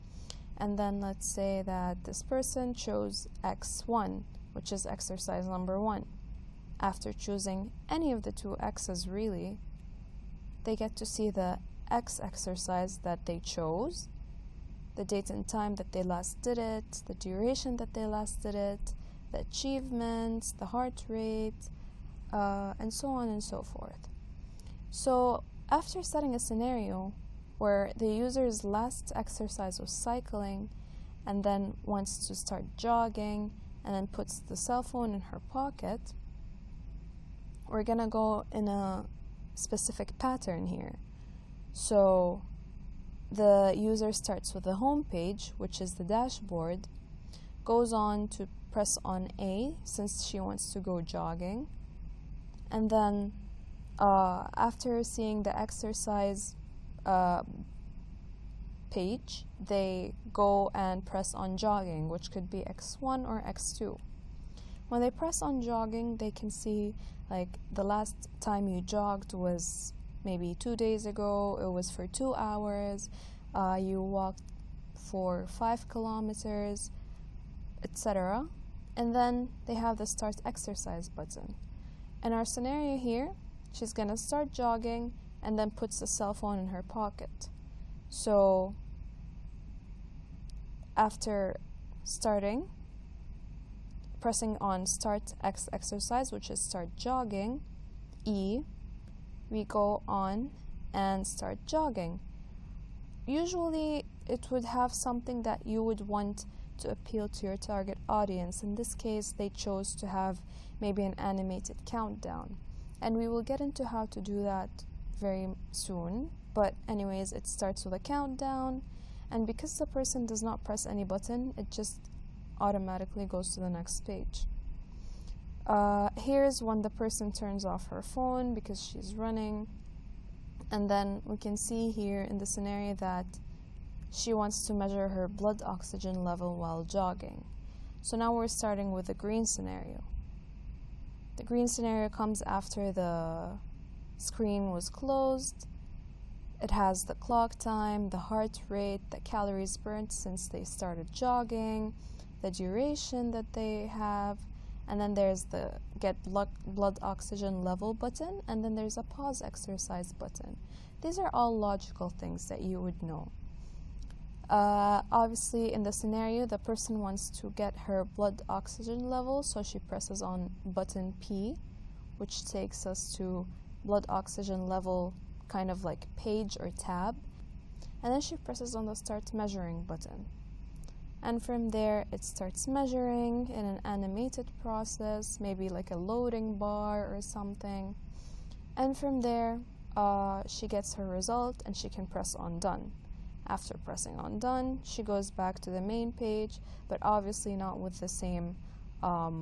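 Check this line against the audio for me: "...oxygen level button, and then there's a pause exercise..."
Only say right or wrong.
right.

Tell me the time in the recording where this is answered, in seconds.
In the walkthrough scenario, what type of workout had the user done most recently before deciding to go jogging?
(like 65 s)
29 s.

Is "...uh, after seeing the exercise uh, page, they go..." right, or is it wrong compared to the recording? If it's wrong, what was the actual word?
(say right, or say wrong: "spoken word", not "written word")
right.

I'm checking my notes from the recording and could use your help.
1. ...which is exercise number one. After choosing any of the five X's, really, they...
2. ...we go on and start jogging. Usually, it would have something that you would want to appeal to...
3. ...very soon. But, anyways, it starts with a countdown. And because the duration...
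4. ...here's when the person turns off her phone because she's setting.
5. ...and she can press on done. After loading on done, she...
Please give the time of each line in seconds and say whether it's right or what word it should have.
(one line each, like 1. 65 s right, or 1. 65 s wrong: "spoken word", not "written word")
1. 4 s wrong: "two", not "five"
2. 99 s right
3. 115 s wrong: "person", not "duration"
4. 126 s wrong: "running", not "setting"
5. 191 s wrong: "pressing", not "loading".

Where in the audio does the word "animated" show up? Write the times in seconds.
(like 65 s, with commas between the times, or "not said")
111 s, 183 s.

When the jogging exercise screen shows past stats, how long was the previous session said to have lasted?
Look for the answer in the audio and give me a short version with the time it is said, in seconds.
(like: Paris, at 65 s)
2 hours, at 72 s.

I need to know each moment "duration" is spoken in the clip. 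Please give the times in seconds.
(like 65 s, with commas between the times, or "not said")
17 s, 152 s.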